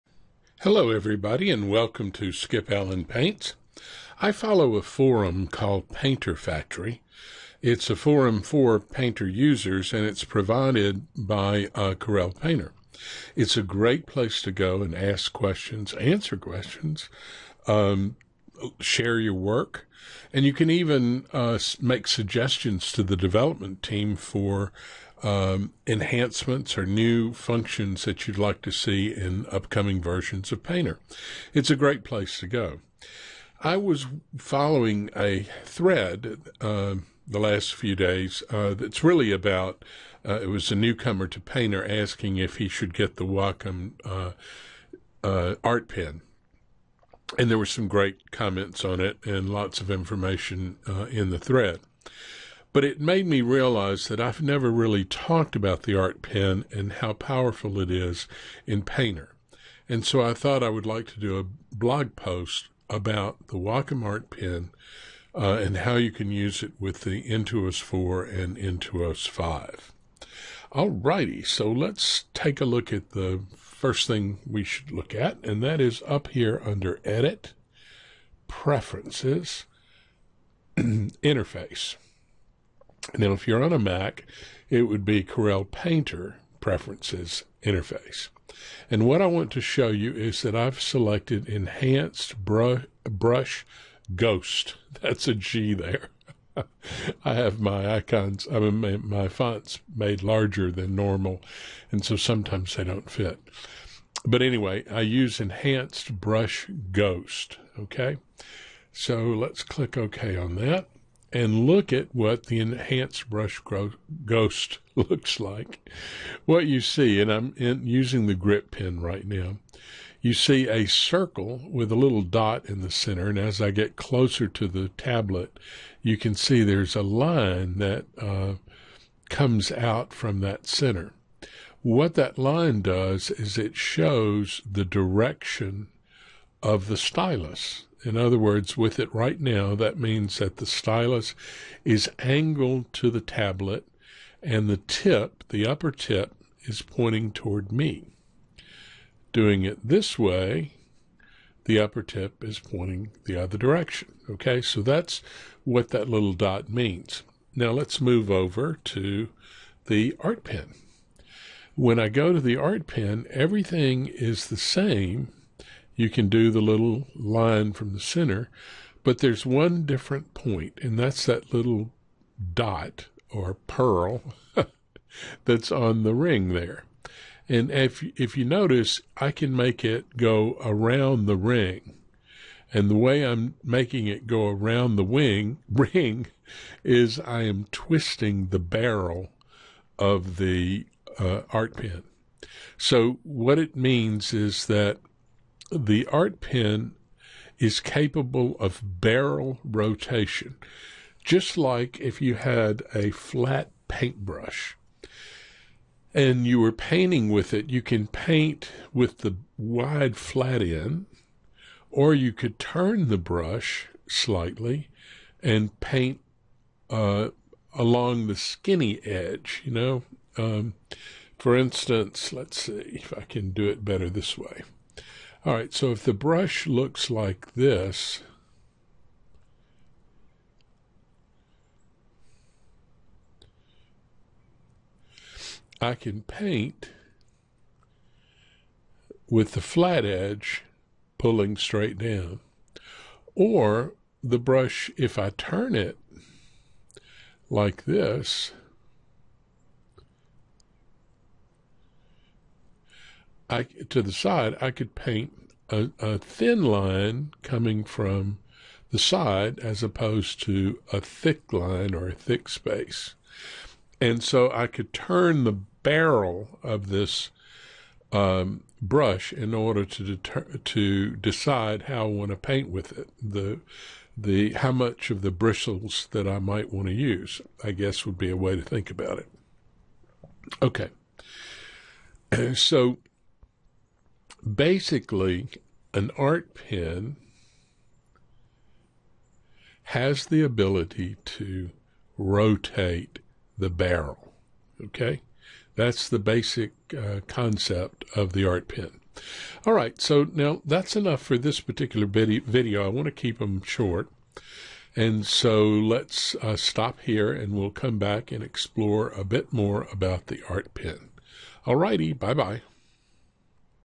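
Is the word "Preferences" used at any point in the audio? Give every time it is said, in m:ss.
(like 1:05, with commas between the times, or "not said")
1:18, 1:26.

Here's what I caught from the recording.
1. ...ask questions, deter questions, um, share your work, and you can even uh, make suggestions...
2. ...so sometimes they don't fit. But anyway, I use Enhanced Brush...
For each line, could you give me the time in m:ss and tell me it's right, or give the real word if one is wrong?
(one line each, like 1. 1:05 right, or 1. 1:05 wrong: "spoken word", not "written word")
1. 0:14 wrong: "answer", not "deter"
2. 1:42 right.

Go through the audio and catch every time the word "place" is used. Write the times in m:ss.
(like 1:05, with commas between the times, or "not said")
0:14, 0:32.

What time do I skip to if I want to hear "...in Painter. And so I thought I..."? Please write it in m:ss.
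0:58.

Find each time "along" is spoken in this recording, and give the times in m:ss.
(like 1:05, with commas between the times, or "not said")
3:37.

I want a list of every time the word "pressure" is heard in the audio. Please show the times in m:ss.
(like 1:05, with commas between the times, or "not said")
not said.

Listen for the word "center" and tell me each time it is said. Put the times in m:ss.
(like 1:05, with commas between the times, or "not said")
2:02, 2:10, 2:47.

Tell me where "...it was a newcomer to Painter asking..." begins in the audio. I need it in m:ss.
0:40.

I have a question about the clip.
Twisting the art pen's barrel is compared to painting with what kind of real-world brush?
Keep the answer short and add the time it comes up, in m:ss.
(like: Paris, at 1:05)
a flat paintbrush, at 3:23.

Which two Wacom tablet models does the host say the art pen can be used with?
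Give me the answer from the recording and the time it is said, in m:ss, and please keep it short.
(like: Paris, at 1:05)
Intuos 4 and Intuos 5, at 1:07.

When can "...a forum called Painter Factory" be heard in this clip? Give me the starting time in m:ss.
0:04.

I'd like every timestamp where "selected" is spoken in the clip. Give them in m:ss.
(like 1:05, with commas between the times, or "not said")
1:30.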